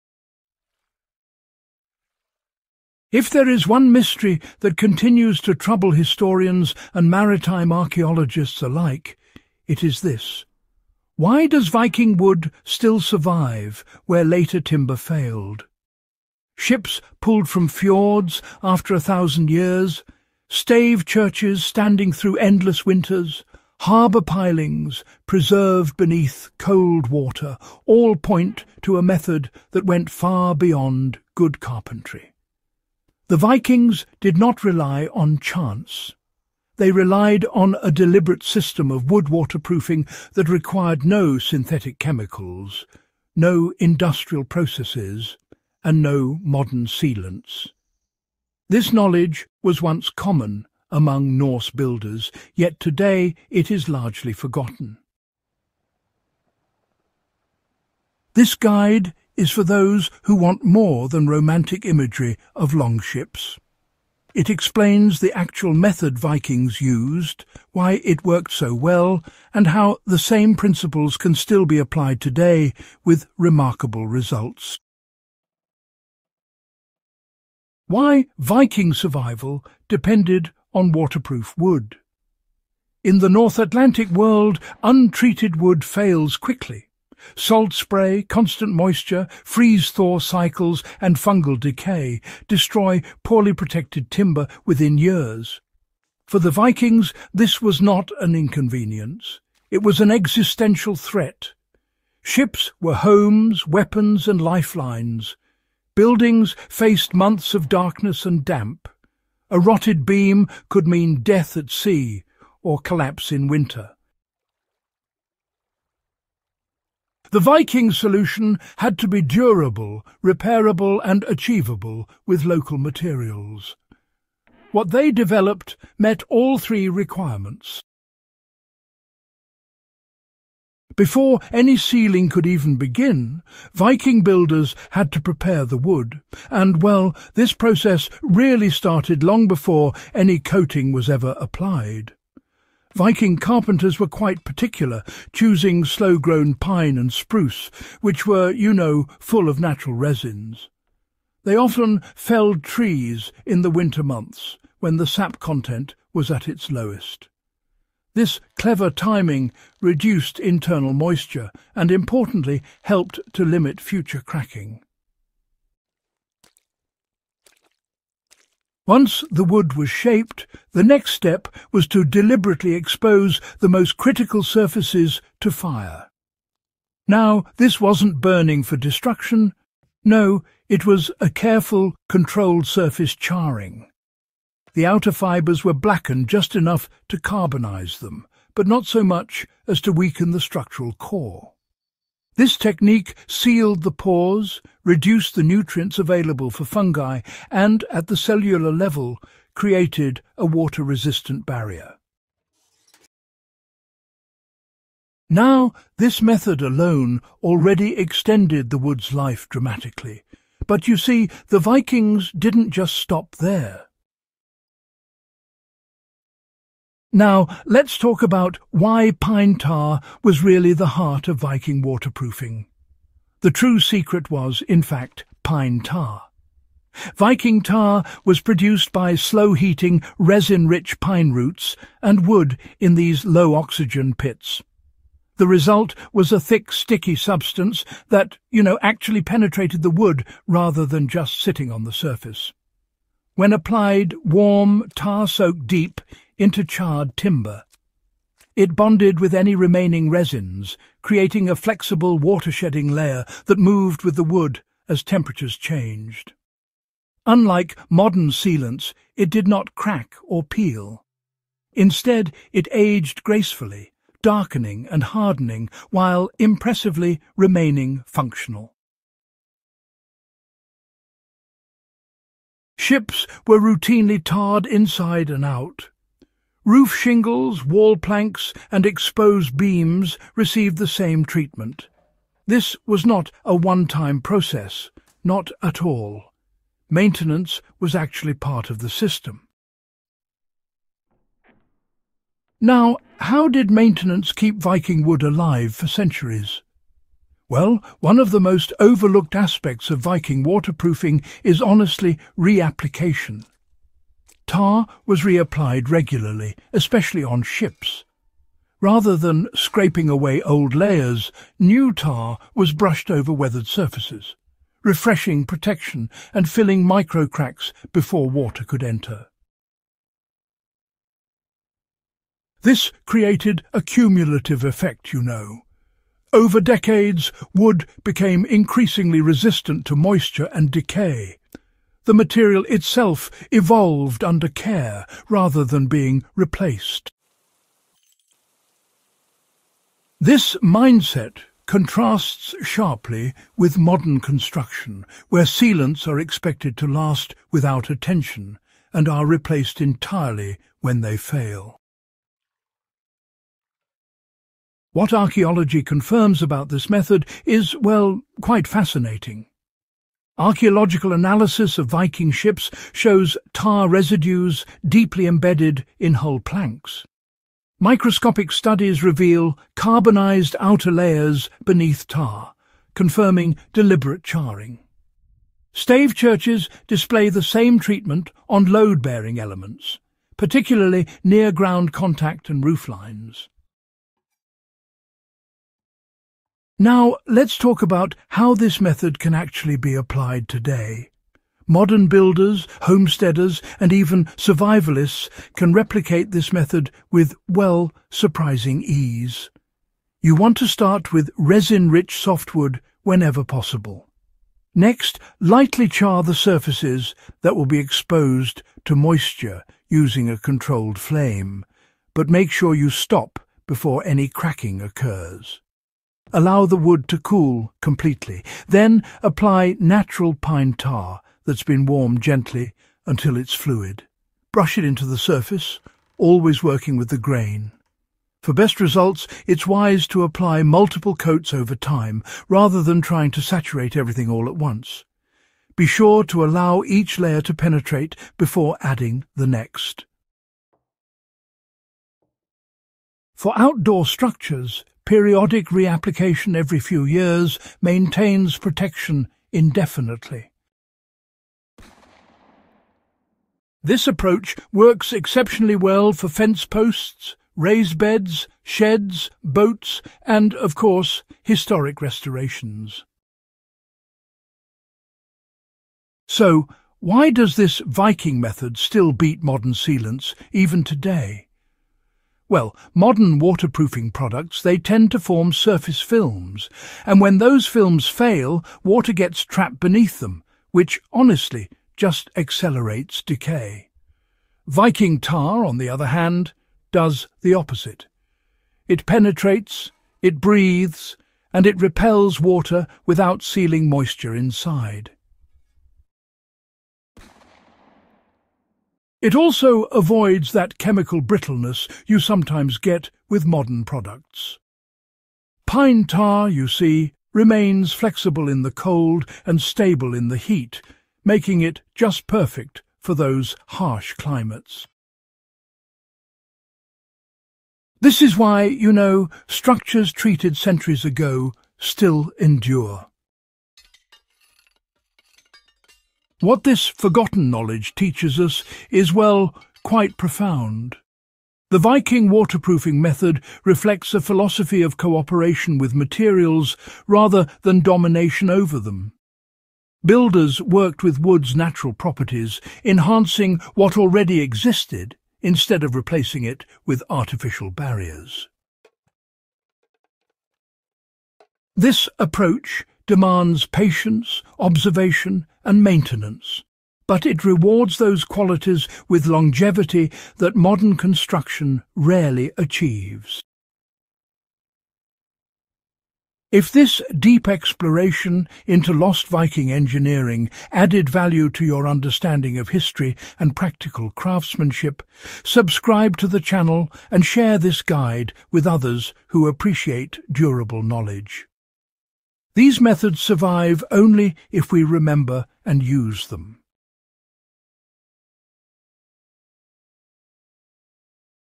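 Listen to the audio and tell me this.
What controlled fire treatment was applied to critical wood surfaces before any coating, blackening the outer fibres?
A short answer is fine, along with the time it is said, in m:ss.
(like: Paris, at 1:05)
Surface charring, at 3:02.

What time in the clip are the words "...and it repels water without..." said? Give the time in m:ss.
8:11.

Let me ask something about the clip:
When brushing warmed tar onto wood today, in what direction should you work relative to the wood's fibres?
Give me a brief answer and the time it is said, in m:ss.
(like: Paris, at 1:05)
With the grain, at 7:06.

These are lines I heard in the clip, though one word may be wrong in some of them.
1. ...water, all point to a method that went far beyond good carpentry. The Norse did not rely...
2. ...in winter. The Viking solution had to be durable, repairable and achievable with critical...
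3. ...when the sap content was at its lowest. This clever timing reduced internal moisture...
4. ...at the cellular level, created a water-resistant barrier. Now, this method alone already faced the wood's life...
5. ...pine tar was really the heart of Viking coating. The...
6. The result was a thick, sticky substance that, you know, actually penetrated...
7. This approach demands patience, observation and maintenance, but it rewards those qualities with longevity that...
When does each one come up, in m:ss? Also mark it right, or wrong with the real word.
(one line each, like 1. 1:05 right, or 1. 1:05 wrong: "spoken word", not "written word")
1. 0:27 wrong: "Vikings", not "Norse"
2. 1:53 wrong: "local", not "critical"
3. 2:34 right
4. 3:17 wrong: "extended", not "faced"
5. 3:39 wrong: "waterproofing", not "coating"
6. 3:55 right
7. 9:11 right.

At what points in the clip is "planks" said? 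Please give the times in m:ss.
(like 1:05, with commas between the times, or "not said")
4:37, 6:06.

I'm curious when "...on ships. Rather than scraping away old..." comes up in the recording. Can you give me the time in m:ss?
5:07.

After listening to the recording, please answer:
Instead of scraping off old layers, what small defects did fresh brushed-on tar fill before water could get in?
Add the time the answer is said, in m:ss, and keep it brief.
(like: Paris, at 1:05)
Microcracks, at 5:16.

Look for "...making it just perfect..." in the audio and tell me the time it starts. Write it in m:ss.
8:31.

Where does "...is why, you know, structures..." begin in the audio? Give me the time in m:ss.
8:38.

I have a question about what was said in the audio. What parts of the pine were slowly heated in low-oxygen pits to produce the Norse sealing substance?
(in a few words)
Roots and wood.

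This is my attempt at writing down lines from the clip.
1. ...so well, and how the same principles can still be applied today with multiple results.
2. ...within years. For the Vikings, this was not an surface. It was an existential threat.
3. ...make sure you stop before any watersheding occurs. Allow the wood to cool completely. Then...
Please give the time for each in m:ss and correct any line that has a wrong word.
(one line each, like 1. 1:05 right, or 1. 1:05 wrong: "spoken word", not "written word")
1. 1:08 wrong: "remarkable", not "multiple"
2. 1:34 wrong: "inconvenience", not "surface"
3. 6:52 wrong: "cracking", not "watersheding".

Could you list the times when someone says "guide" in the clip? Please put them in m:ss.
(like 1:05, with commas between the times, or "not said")
0:58, 9:37.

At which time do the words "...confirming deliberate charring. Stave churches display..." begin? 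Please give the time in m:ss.
6:12.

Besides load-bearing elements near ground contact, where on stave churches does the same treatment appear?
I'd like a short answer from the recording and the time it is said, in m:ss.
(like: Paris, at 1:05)
Roof lines, at 6:22.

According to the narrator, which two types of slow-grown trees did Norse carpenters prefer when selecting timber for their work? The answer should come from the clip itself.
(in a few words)
Pine and spruce.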